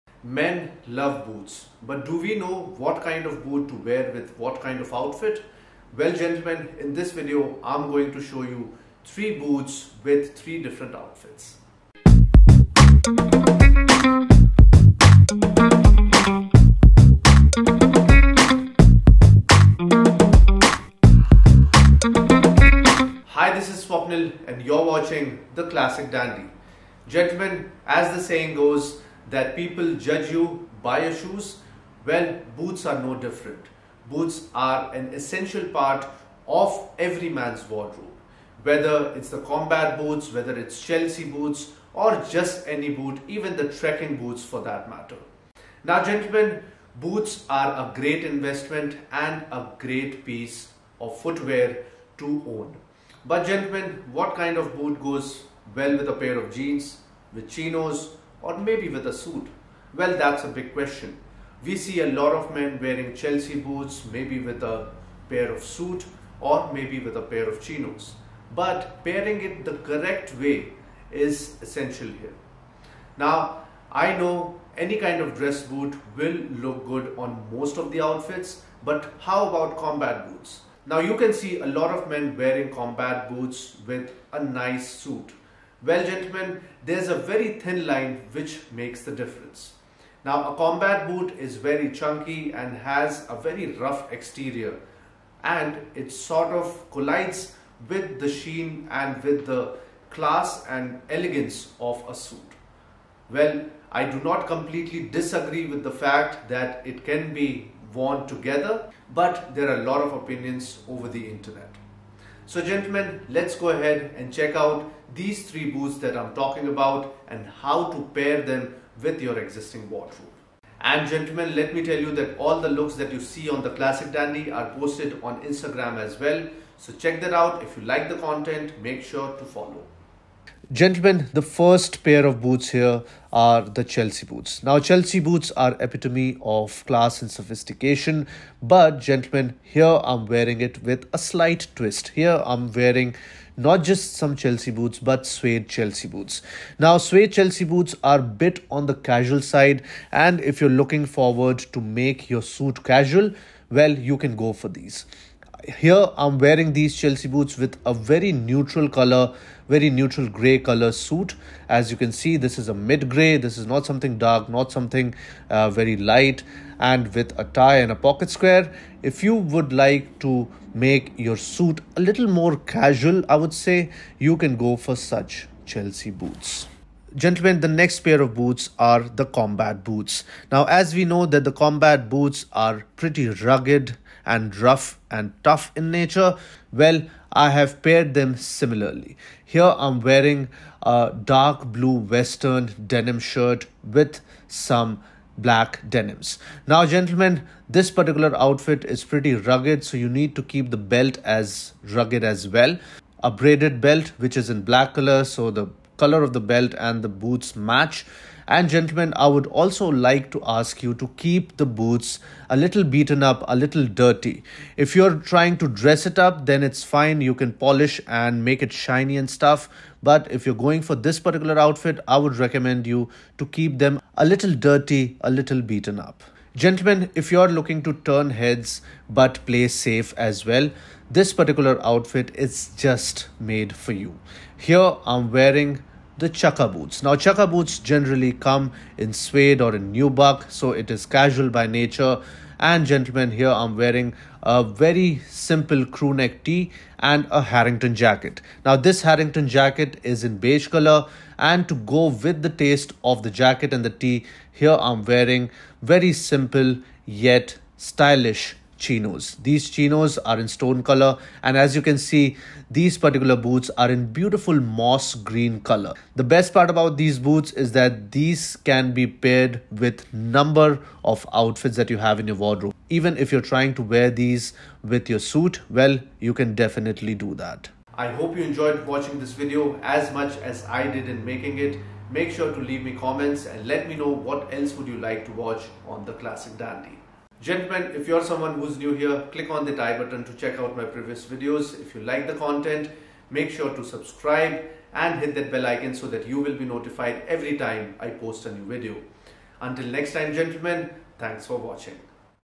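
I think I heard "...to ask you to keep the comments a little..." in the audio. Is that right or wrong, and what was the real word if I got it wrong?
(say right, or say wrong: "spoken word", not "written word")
wrong: "boots", not "comments".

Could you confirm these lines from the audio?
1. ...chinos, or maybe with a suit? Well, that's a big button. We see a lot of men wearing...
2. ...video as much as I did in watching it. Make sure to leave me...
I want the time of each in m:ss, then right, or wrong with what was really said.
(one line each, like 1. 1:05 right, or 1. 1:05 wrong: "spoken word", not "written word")
1. 0:57 wrong: "question", not "button"
2. 4:39 wrong: "making", not "watching".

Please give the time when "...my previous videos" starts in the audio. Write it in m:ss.
4:50.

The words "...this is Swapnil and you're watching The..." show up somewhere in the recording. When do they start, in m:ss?
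0:23.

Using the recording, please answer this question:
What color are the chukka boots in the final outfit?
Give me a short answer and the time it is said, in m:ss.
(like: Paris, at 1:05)
Moss green, at 4:24.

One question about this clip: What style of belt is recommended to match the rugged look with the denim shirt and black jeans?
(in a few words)
Braided belt.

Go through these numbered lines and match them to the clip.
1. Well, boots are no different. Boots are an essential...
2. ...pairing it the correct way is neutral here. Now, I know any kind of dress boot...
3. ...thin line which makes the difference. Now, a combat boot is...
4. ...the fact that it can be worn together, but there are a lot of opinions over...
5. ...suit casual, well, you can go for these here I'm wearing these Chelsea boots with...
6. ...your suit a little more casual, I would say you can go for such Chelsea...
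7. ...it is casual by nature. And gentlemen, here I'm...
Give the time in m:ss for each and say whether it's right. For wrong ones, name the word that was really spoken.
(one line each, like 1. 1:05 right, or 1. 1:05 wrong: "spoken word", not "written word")
1. 0:32 right
2. 1:09 wrong: "essential", not "neutral"
3. 1:27 right
4. 1:45 right
5. 2:32 right
6. 2:51 right
7. 4:00 right.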